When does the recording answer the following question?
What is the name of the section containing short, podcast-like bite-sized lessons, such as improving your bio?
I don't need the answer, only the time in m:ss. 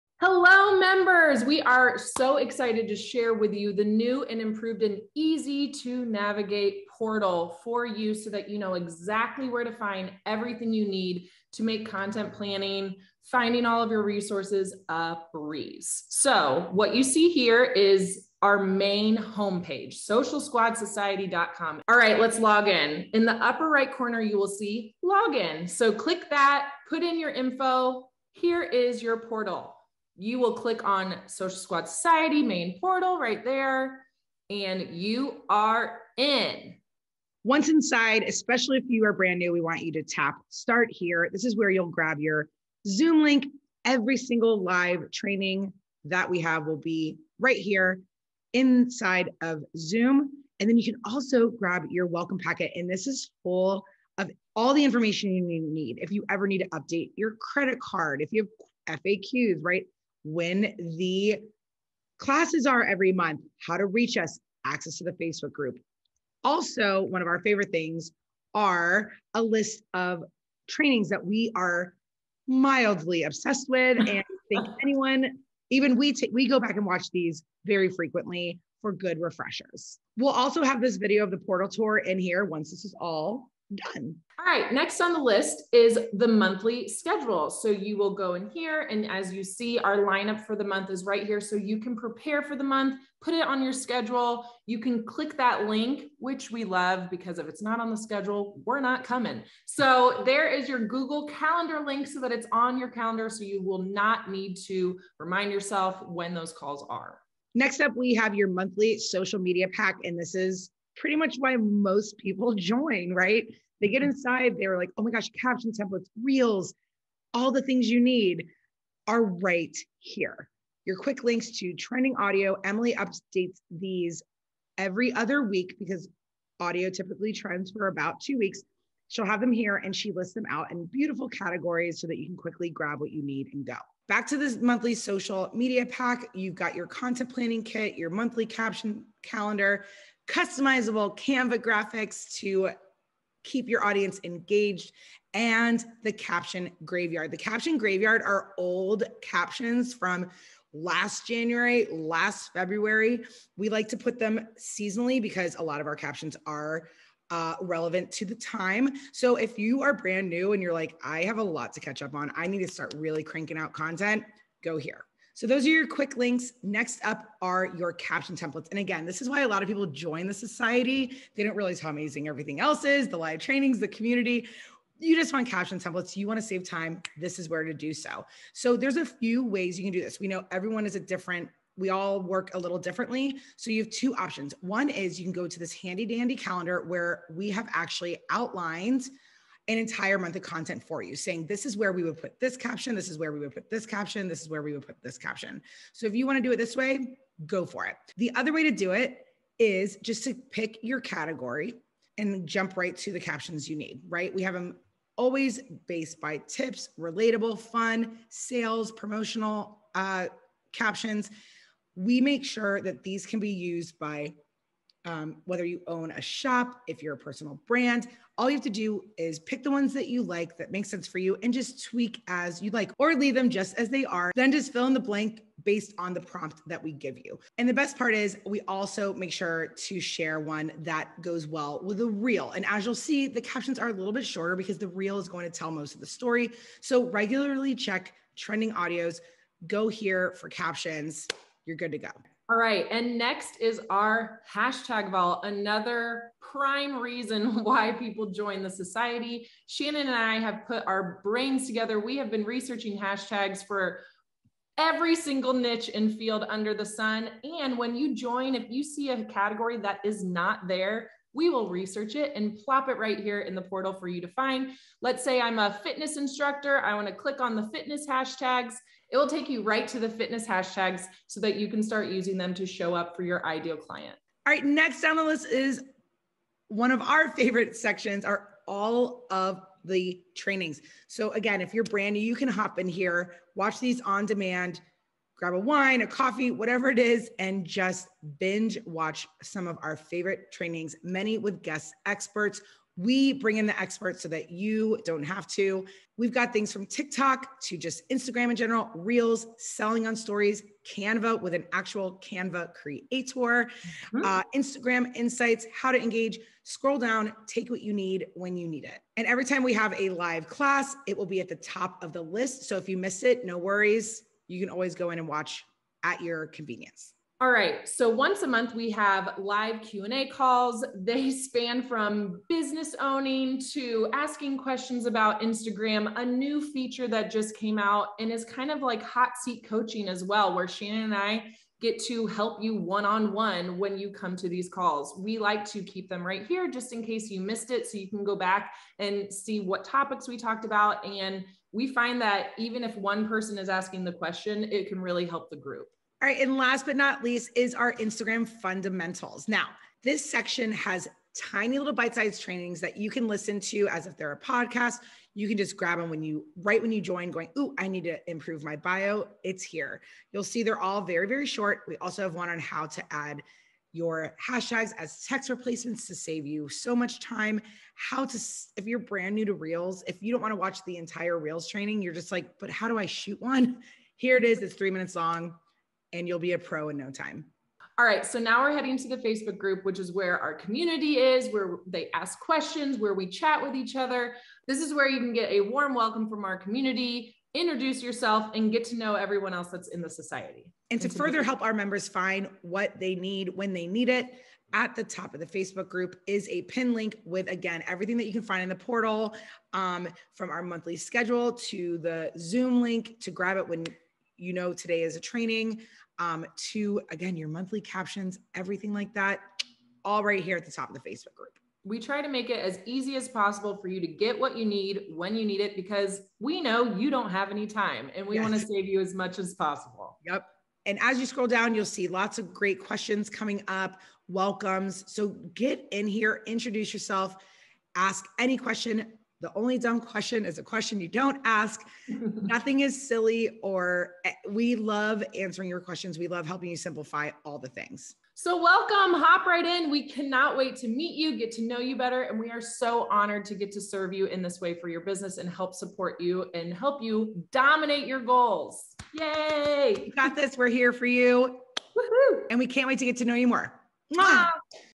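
5:47.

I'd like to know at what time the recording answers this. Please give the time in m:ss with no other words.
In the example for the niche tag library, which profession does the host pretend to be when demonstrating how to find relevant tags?
4:25.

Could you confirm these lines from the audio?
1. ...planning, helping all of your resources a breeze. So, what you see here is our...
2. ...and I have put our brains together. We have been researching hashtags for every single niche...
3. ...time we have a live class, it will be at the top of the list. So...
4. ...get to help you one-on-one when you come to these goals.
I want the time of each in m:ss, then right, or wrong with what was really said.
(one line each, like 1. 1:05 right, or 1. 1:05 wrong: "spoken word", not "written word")
1. 0:12 wrong: "finding", not "helping"
2. 4:10 right
3. 5:09 right
4. 5:31 wrong: "calls", not "goals".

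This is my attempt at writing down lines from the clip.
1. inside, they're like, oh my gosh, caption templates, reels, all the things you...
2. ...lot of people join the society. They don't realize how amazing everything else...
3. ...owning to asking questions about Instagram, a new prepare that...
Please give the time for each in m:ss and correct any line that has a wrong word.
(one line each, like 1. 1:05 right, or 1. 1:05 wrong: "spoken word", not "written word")
1. 1:54 right
2. 2:49 right
3. 5:22 wrong: "feature", not "prepare".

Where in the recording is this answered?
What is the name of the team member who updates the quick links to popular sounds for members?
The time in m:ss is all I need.
2:02.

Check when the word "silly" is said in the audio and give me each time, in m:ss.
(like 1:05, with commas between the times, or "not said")
7:13.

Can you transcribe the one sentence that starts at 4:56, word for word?
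We've got things from TikTok to just Instagram in general, Reels, selling on stories, Canva with an actual Canva creator, mm-hmm.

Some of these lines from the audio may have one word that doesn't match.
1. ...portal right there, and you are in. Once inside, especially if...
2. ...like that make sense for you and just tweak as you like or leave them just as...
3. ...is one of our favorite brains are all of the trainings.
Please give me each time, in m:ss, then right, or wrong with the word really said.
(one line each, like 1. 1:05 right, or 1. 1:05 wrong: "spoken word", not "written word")
1. 0:32 right
2. 3:40 right
3. 4:35 wrong: "sections", not "brains".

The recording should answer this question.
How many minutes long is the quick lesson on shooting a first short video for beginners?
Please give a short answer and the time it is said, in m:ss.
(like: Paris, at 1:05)
3 minutes, at 6:14.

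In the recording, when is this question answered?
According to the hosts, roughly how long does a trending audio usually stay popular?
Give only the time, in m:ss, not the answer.
2:07.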